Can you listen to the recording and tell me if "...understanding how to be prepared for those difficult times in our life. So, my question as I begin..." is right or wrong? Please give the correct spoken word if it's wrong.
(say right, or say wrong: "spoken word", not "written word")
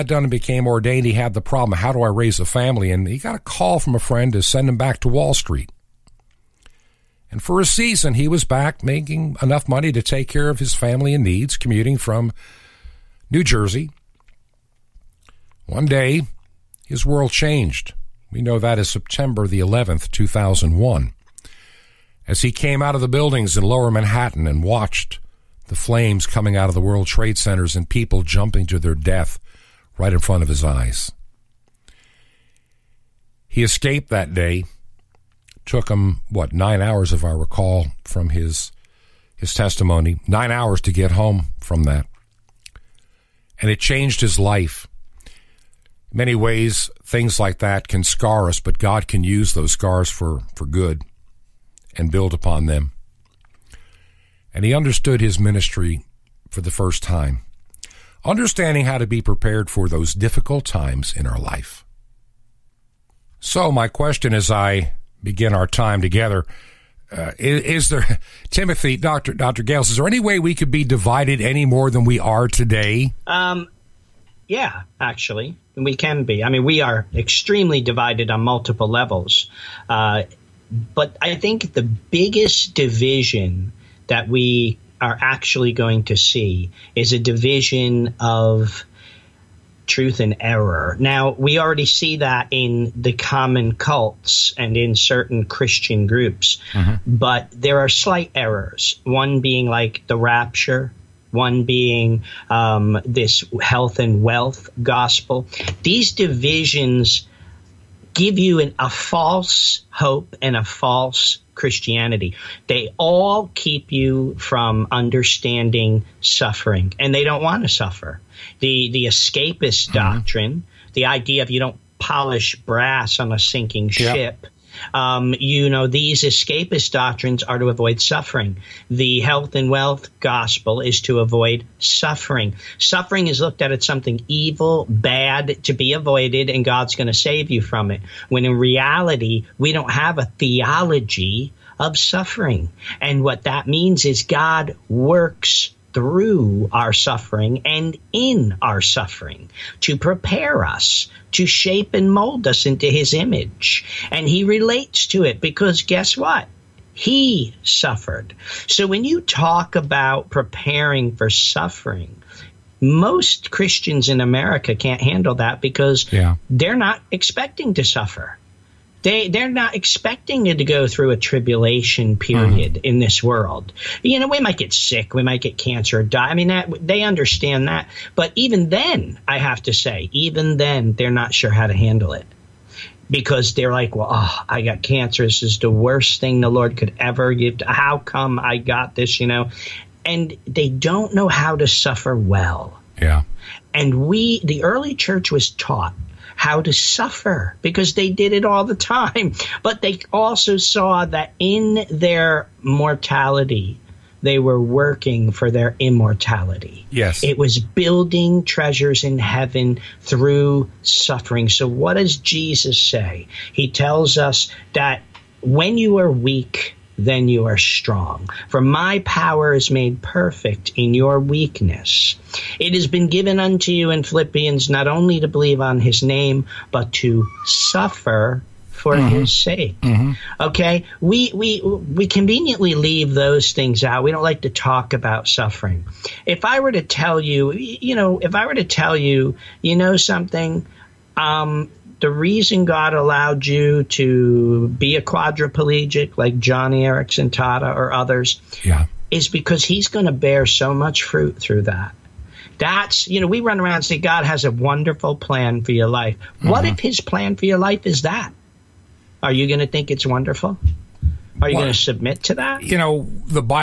right.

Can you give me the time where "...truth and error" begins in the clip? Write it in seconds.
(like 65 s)
89 s.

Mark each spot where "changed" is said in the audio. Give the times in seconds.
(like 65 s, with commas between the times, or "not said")
17 s, 43 s.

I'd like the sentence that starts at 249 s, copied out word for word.
is because he's going to bear so much fruit through that.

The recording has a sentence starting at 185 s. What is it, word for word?
This is the worst thing the Lord could ever give.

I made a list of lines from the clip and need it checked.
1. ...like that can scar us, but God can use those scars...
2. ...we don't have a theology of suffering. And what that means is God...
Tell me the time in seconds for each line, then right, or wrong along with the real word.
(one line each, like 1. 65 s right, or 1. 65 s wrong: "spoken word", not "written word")
1. 47 s right
2. 139 s right.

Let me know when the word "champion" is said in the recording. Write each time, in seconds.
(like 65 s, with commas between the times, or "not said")
not said.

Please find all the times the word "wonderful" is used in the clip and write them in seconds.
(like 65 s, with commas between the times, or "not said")
254 s, 260 s.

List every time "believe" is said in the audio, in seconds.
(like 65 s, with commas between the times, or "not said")
225 s.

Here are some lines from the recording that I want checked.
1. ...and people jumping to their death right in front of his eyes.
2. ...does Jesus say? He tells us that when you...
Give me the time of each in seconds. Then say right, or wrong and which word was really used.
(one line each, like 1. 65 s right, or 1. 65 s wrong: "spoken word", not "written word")
1. 27 s right
2. 211 s right.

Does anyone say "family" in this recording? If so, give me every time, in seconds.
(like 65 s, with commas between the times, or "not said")
2 s, 10 s.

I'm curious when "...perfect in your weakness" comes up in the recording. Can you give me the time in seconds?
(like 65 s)
220 s.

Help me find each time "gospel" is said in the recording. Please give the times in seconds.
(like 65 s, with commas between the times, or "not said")
104 s, 130 s.